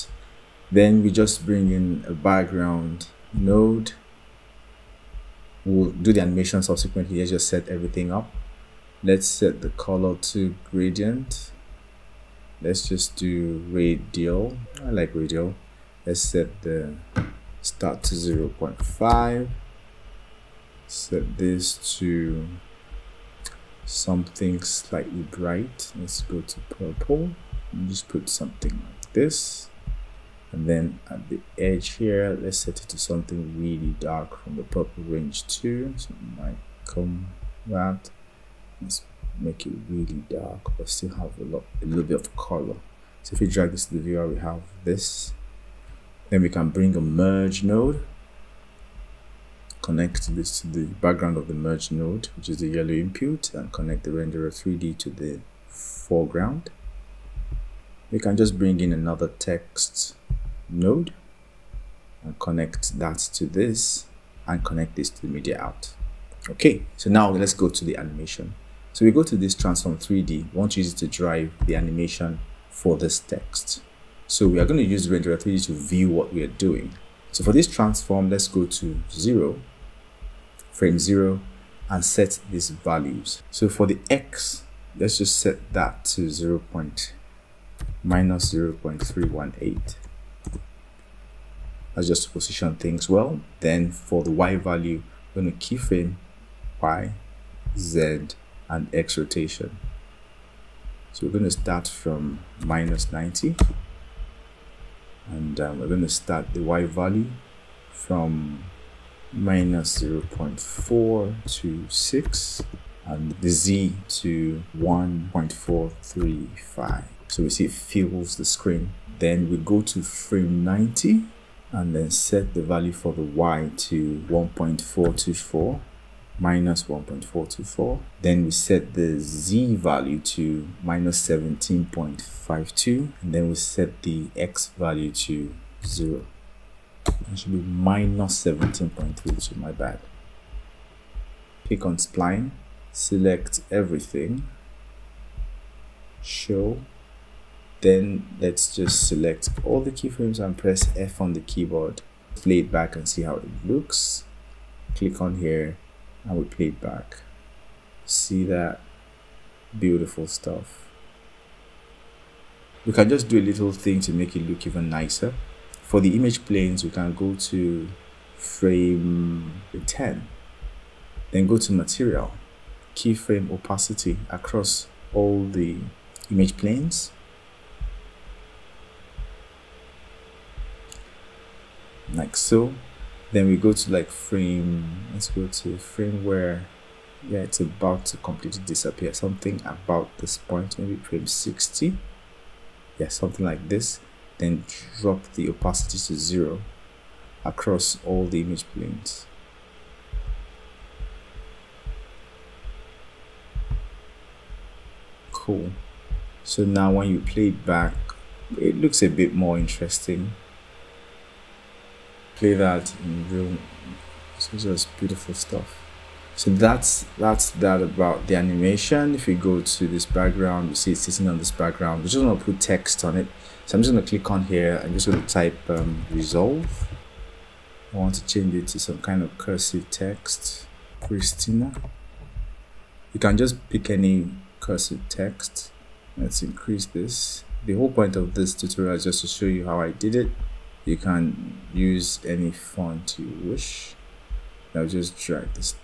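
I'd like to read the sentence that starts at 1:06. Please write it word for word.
Okay, so now let's go to the animation.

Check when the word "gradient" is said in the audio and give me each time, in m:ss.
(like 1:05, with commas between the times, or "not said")
0:10.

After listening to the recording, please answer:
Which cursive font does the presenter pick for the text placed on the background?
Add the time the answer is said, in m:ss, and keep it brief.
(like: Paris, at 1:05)
Christina, at 3:51.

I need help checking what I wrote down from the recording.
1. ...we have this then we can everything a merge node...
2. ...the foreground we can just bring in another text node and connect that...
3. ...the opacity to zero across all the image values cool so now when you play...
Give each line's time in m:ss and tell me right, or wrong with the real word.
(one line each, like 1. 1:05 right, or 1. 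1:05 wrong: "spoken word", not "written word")
1. 0:44 wrong: "bring", not "everything"
2. 0:55 right
3. 3:15 wrong: "planes", not "values".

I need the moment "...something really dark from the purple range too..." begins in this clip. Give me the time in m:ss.
0:32.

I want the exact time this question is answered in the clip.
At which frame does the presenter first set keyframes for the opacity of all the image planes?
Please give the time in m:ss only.
2:48.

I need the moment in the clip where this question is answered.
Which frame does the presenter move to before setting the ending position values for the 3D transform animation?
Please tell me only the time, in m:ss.
2:00.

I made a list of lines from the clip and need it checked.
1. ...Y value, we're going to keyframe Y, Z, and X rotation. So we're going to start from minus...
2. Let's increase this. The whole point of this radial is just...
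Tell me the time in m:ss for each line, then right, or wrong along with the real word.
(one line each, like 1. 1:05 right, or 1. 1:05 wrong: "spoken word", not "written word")
1. 1:34 right
2. 3:56 wrong: "tutorial", not "radial".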